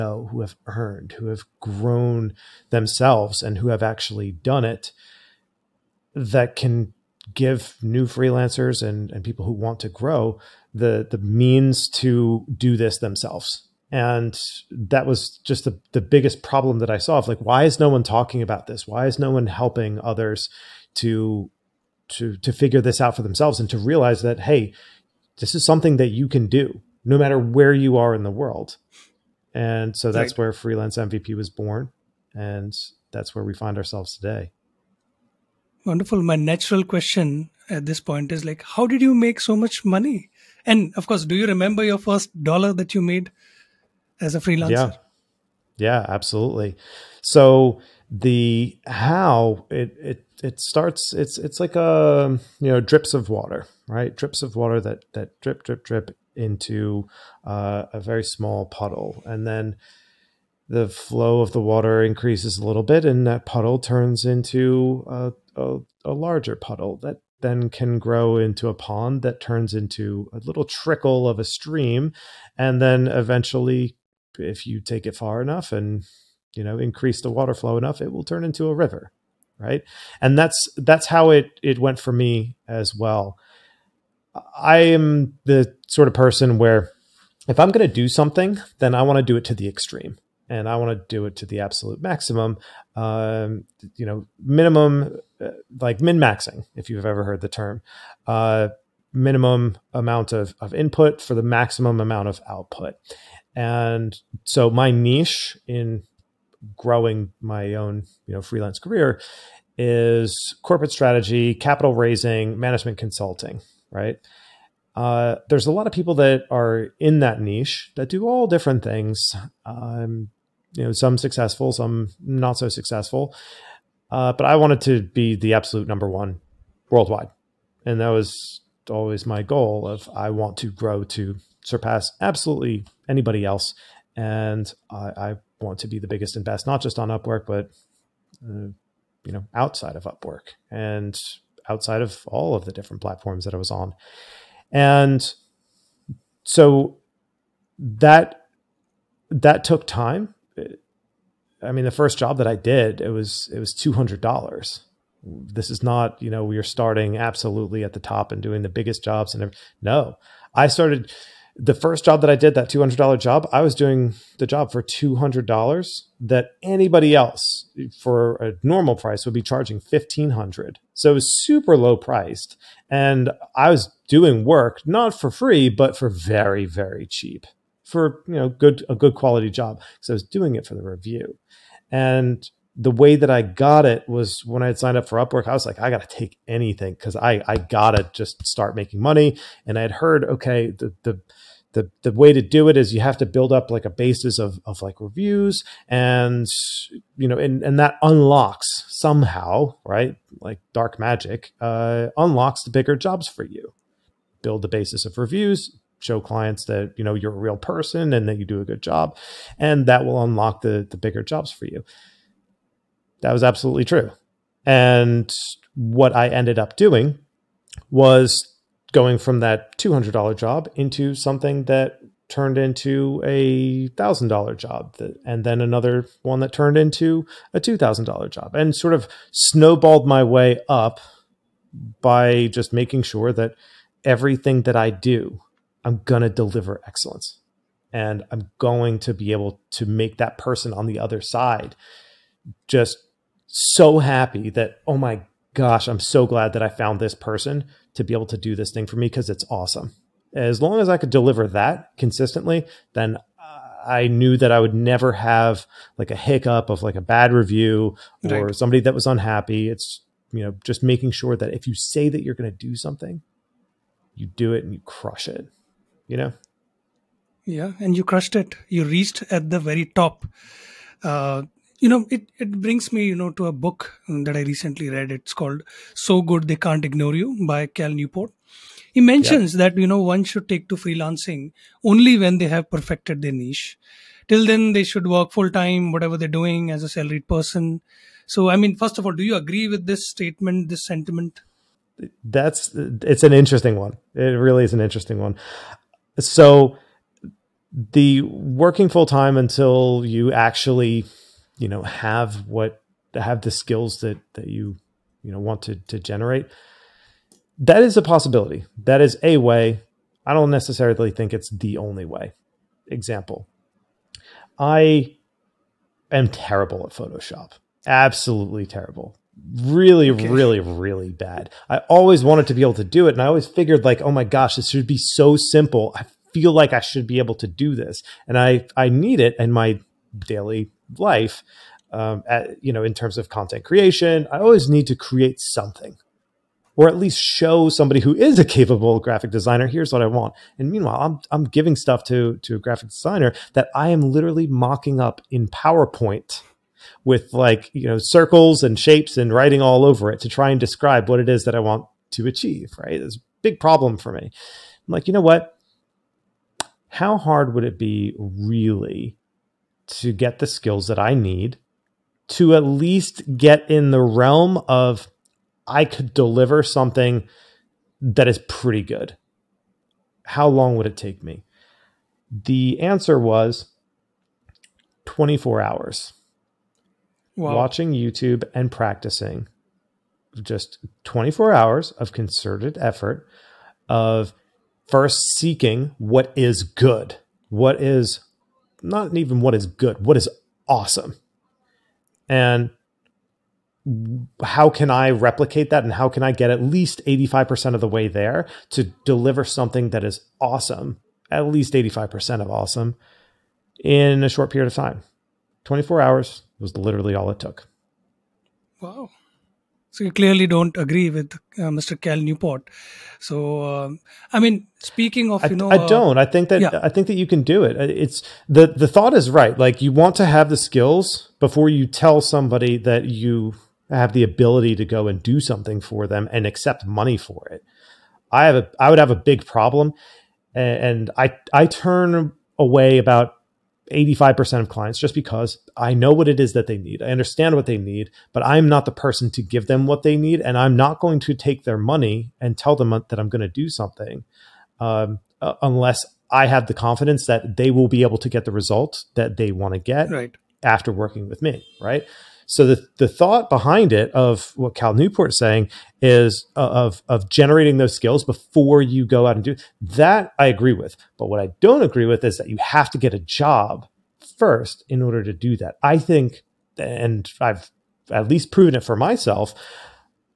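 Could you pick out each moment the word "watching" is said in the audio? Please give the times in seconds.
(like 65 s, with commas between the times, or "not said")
377 s.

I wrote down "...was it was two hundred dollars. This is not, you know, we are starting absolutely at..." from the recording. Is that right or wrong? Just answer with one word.
right.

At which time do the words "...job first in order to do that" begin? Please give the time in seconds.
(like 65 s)
463 s.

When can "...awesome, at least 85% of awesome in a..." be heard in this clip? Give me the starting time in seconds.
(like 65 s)
400 s.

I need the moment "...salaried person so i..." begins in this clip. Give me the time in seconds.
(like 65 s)
286 s.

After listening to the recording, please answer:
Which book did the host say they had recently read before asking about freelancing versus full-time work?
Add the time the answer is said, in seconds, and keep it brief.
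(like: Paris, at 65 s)
So Good They Can't Ignore You, at 275 s.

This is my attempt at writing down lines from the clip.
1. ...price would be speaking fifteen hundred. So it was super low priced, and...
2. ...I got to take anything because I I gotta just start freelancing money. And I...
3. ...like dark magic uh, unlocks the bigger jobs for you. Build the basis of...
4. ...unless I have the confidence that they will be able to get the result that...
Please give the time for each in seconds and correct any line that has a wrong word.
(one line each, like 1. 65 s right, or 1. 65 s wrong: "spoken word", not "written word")
1. 168 s wrong: "charging", not "speaking"
2. 185 s wrong: "making", not "freelancing"
3. 200 s right
4. 445 s right.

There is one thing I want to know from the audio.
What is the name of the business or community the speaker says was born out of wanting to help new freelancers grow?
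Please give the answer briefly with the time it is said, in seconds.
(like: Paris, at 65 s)
Freelance MVP, at 30 s.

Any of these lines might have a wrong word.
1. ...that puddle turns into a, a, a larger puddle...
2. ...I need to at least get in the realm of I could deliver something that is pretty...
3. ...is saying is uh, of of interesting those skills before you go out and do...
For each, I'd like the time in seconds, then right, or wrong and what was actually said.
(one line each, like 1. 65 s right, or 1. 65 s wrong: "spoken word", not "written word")
1. 63 s right
2. 360 s right
3. 455 s wrong: "generating", not "interesting".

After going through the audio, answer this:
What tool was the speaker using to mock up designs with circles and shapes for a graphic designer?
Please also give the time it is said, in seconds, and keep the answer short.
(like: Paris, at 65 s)
PowerPoint, at 345 s.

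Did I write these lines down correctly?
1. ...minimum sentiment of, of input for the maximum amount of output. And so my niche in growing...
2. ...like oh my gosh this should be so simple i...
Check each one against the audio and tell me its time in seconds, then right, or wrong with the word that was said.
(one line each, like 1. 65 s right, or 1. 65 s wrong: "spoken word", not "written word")
1. 99 s wrong: "amount", not "sentiment"
2. 323 s right.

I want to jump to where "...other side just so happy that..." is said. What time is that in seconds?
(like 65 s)
240 s.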